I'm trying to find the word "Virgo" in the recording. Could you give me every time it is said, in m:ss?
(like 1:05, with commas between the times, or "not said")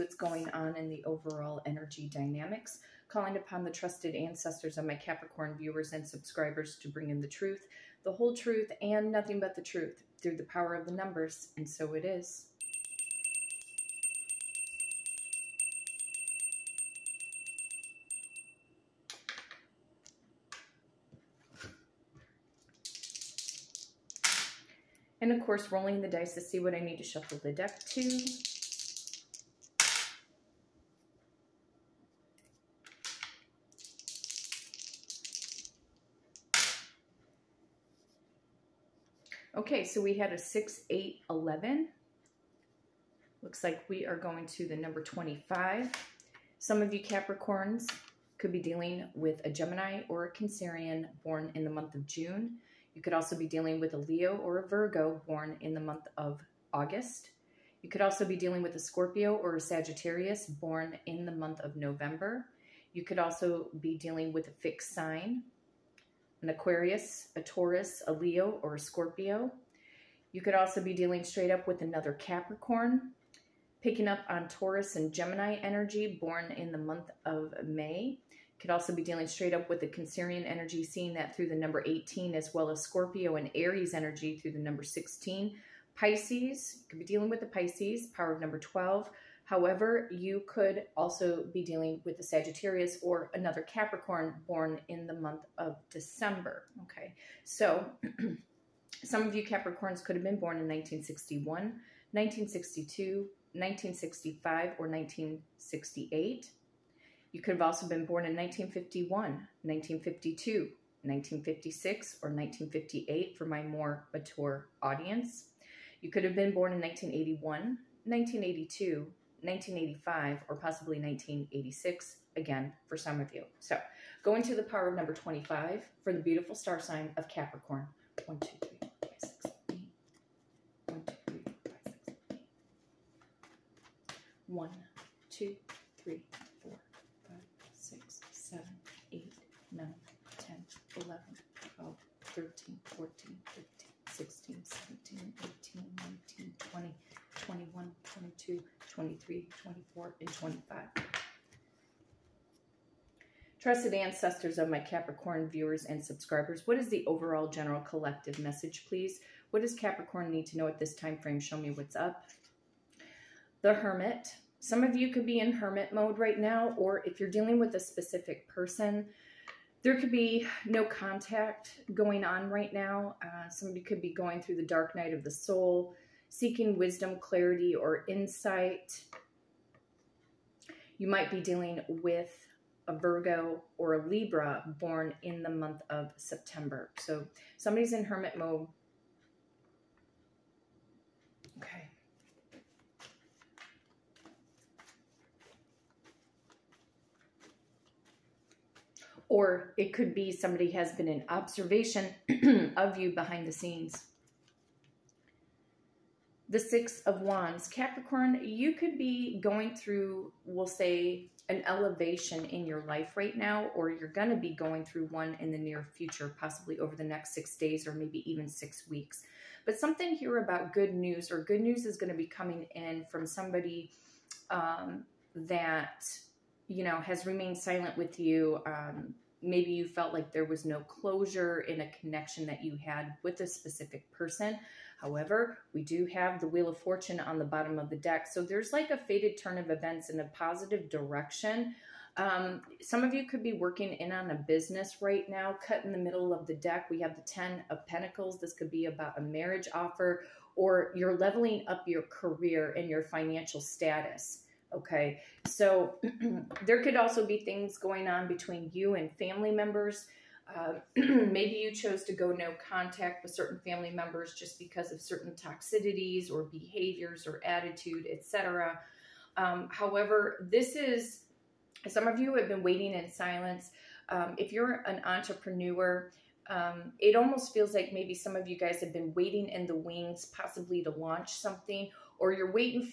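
0:54, 3:02.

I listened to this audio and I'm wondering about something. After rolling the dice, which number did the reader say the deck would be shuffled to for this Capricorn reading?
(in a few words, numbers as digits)
25.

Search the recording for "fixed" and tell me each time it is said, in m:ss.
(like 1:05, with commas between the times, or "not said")
1:04.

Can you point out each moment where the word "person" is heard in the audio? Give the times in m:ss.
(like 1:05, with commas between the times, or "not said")
2:48, 3:54.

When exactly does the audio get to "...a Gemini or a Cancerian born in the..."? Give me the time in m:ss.
0:49.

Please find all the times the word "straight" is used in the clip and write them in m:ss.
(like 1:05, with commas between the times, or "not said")
1:11, 1:19.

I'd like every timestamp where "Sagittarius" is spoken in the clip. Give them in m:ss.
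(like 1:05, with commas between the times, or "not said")
0:59, 1:32.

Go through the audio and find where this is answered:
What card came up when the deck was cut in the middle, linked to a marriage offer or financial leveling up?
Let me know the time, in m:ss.
4:07.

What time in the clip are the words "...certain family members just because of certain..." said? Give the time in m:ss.
4:23.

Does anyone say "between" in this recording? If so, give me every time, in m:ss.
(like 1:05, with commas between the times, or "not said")
4:18.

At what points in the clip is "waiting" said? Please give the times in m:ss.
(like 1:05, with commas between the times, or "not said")
4:32, 4:39.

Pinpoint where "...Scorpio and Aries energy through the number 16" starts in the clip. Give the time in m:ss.
1:22.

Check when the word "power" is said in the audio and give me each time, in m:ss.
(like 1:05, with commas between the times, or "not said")
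0:10, 1:28, 2:04.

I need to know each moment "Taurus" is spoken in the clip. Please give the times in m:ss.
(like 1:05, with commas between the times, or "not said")
1:07, 1:14.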